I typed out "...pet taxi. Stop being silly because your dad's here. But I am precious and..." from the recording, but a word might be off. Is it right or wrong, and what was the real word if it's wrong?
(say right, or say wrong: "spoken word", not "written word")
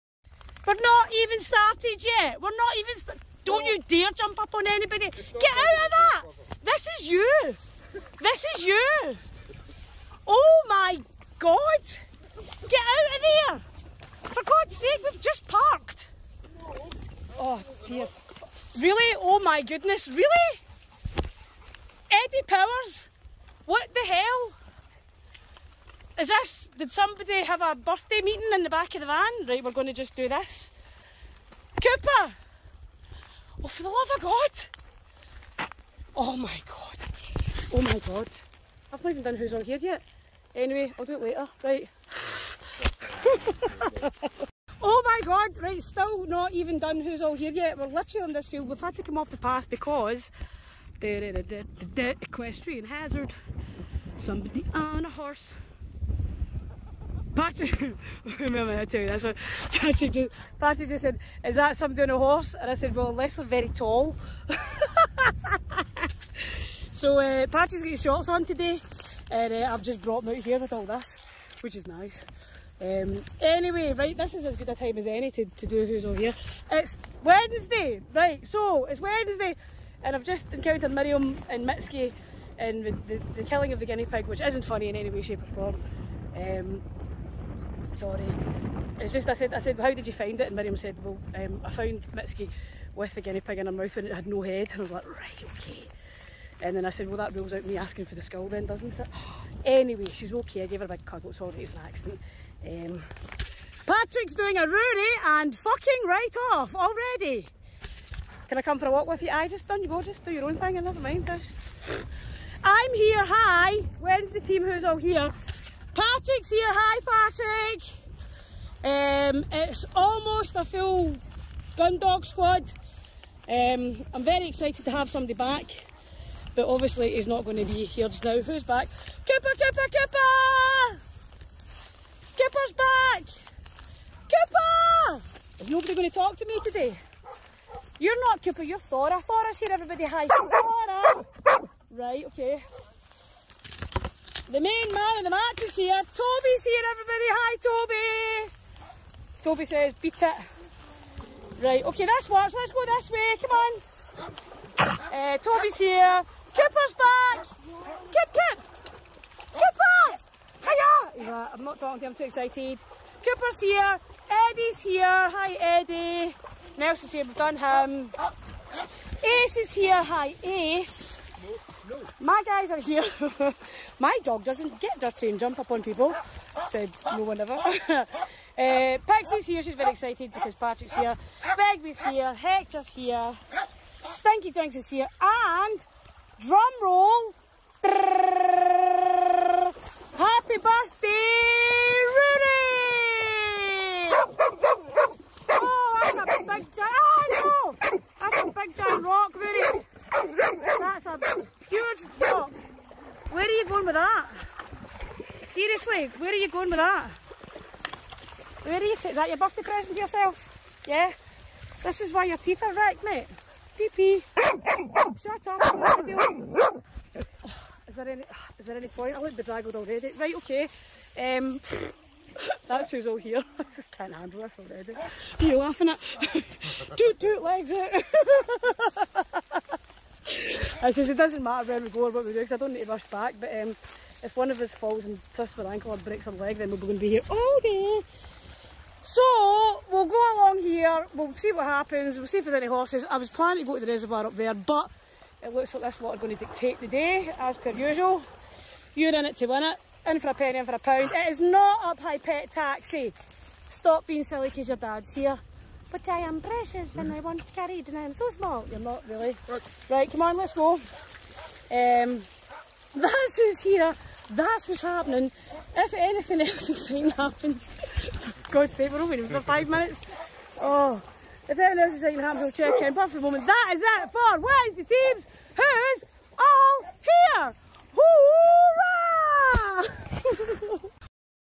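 right.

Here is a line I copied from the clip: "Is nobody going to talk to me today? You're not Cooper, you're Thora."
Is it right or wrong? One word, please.
right.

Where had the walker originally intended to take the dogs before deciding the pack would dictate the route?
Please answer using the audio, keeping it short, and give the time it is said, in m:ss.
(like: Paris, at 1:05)
The reservoir, at 4:03.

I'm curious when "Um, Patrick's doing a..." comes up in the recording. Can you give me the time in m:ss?
1:42.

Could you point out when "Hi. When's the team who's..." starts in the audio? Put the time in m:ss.
1:53.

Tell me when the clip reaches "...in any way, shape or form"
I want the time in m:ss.
1:24.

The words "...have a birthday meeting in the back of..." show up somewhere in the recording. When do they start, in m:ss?
0:27.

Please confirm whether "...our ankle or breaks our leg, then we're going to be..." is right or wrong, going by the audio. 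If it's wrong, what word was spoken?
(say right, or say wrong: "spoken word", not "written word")
right.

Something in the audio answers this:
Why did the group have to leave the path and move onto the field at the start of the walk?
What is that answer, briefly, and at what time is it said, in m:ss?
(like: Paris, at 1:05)
Equestrian hazard, at 0:52.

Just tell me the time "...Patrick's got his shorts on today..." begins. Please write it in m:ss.
1:07.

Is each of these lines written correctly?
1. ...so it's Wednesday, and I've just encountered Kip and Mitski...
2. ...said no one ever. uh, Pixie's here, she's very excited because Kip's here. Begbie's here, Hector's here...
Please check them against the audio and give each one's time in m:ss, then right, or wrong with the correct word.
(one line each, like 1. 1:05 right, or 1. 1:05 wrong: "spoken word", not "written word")
1. 1:18 wrong: "Miriam", not "Kip"
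2. 2:56 wrong: "Patrick", not "Kip".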